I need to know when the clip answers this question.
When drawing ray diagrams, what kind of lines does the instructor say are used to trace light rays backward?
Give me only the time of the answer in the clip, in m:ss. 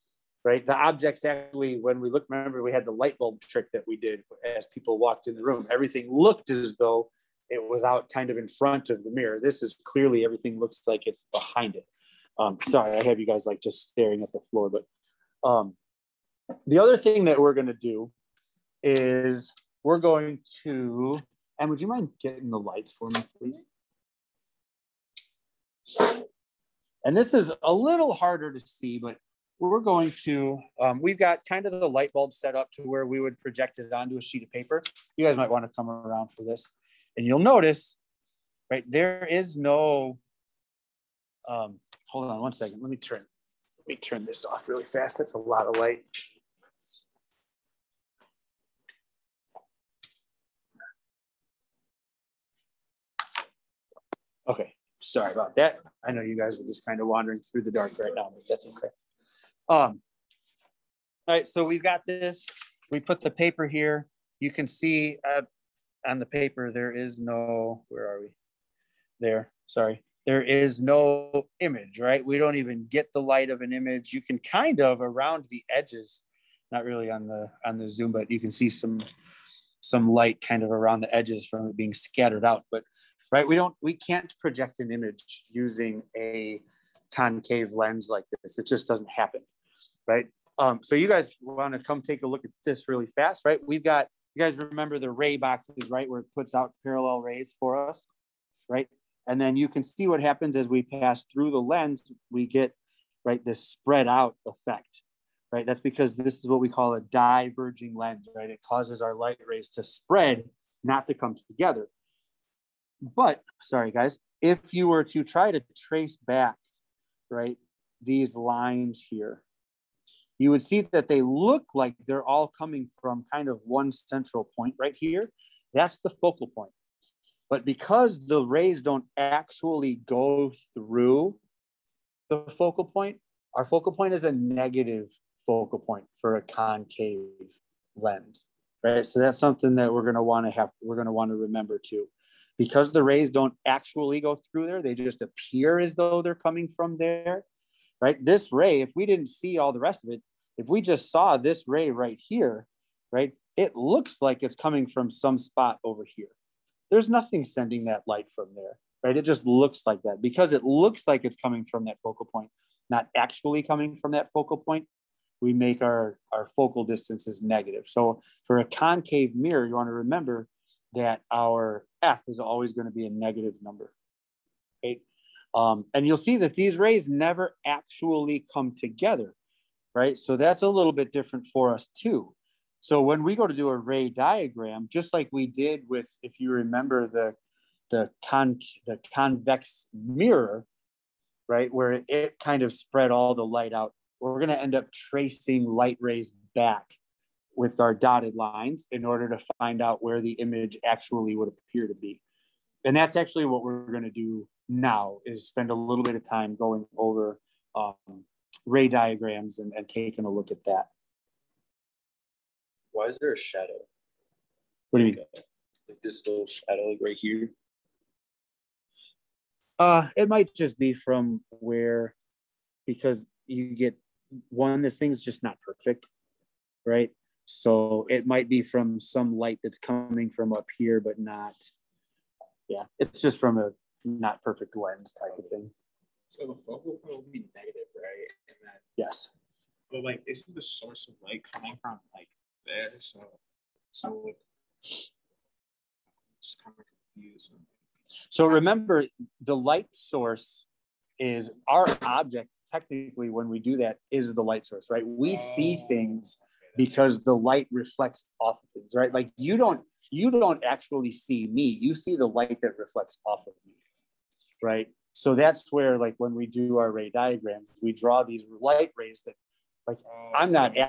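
3:17.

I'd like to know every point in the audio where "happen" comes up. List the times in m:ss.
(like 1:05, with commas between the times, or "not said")
1:29, 1:40.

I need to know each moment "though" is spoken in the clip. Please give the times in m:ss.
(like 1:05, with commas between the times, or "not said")
0:06, 2:25.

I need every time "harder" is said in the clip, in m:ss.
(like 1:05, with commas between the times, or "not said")
0:28.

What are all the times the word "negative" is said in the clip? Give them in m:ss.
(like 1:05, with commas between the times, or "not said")
2:14, 2:47, 2:53, 3:57.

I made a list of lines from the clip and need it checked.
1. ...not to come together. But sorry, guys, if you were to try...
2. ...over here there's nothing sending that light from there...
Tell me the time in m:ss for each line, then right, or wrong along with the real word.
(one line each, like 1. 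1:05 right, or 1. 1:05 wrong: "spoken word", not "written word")
1. 1:50 right
2. 2:35 right.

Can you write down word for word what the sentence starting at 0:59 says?
Um, all right, so we've got this.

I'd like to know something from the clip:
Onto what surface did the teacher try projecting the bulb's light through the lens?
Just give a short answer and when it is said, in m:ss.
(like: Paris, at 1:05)
sheet of paper, at 0:34.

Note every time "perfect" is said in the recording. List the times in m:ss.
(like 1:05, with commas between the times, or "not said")
3:45, 3:54.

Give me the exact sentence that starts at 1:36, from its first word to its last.
Where it puts out parallel rays for us, right?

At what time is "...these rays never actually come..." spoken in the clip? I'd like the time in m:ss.
2:56.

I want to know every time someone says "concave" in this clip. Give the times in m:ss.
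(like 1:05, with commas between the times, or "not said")
1:27, 2:16, 2:48.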